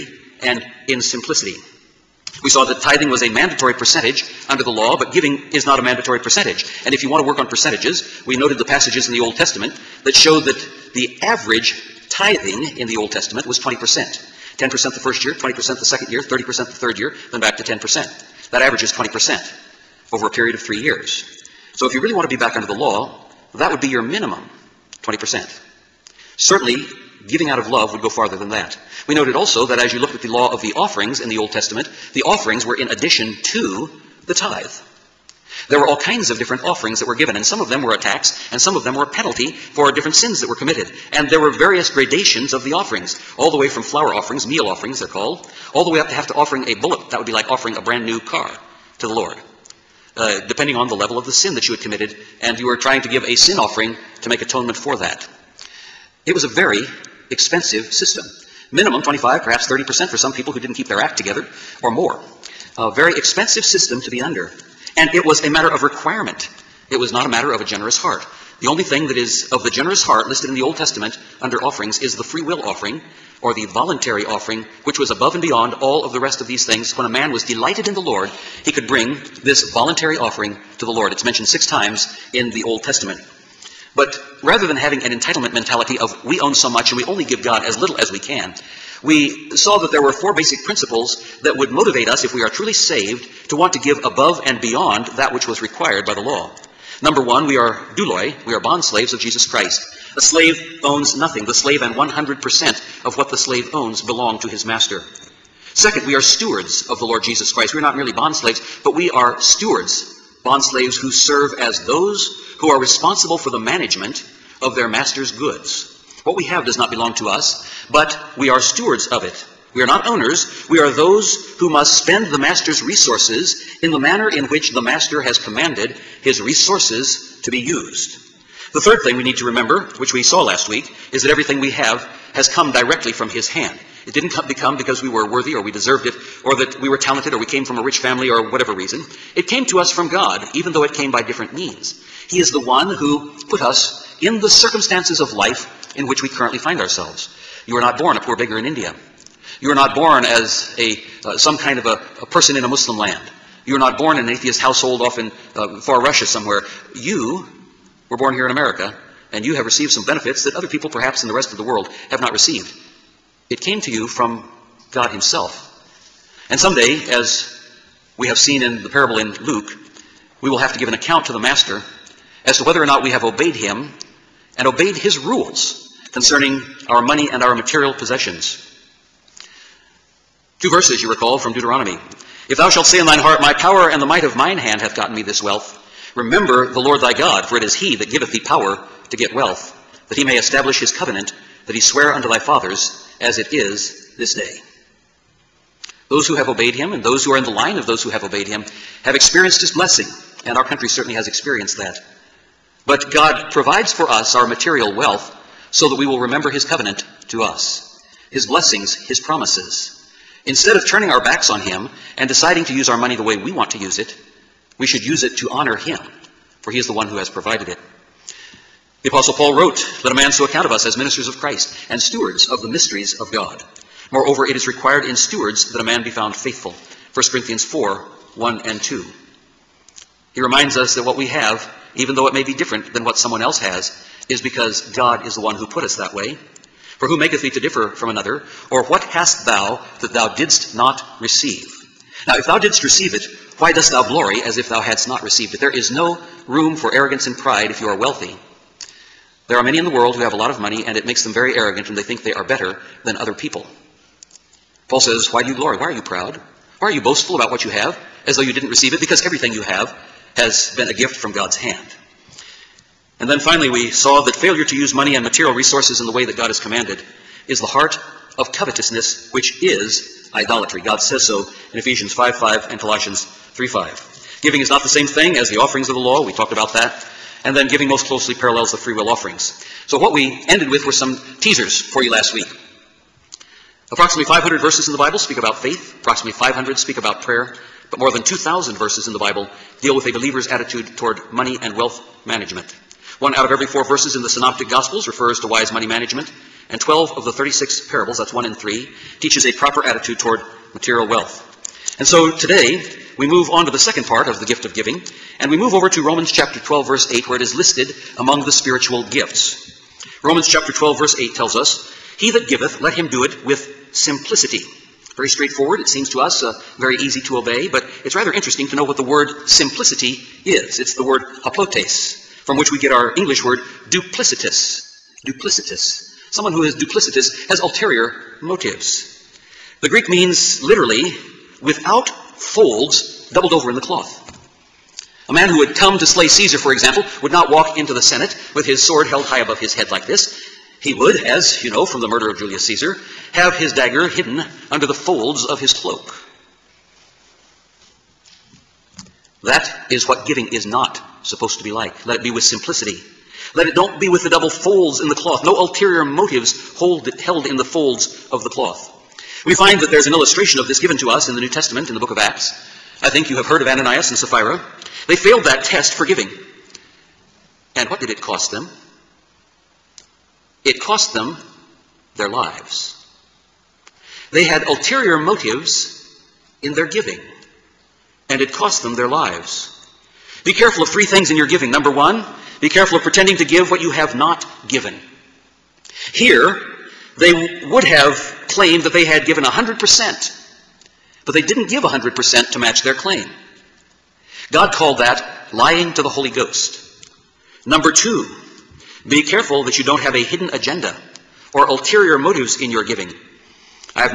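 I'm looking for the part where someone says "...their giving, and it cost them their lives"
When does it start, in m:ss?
6:16.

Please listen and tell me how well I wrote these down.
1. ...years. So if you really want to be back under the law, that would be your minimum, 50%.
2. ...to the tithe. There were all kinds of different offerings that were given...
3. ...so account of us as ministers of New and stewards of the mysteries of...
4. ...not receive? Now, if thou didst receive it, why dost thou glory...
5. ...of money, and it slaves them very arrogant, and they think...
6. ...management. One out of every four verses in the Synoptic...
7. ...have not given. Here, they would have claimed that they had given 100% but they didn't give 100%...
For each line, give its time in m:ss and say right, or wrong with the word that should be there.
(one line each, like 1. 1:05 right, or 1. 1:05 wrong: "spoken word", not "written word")
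1. 0:20 wrong: "20", not "50"
2. 0:33 right
3. 3:40 wrong: "Christ", not "New"
4. 4:00 right
5. 4:10 wrong: "makes", not "slaves"
6. 4:52 right
7. 6:23 right.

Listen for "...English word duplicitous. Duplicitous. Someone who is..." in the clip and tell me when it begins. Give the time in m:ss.
5:23.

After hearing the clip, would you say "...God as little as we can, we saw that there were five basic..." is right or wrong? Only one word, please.
wrong.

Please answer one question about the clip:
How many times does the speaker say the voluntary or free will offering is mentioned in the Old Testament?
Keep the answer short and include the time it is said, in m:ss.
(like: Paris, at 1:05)
6, at 1:21.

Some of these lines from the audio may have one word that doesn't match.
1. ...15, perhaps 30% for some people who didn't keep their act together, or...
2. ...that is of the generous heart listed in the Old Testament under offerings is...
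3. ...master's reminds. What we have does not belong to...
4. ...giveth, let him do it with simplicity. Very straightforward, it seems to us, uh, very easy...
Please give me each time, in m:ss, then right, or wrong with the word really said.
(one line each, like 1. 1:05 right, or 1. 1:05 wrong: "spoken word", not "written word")
1. 0:59 wrong: "25", not "15"
2. 1:09 right
3. 1:54 wrong: "goods", not "reminds"
4. 5:12 right.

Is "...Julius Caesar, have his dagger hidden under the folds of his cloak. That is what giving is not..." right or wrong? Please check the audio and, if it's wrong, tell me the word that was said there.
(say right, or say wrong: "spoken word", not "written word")
right.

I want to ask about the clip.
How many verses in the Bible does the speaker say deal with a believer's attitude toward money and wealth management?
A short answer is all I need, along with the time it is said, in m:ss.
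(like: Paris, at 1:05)
More than 2,000, at 4:47.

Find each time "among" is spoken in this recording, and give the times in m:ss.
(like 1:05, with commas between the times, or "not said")
5:08.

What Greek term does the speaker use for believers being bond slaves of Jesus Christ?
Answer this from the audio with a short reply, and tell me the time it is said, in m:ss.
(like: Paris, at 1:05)
Douloi, at 1:37.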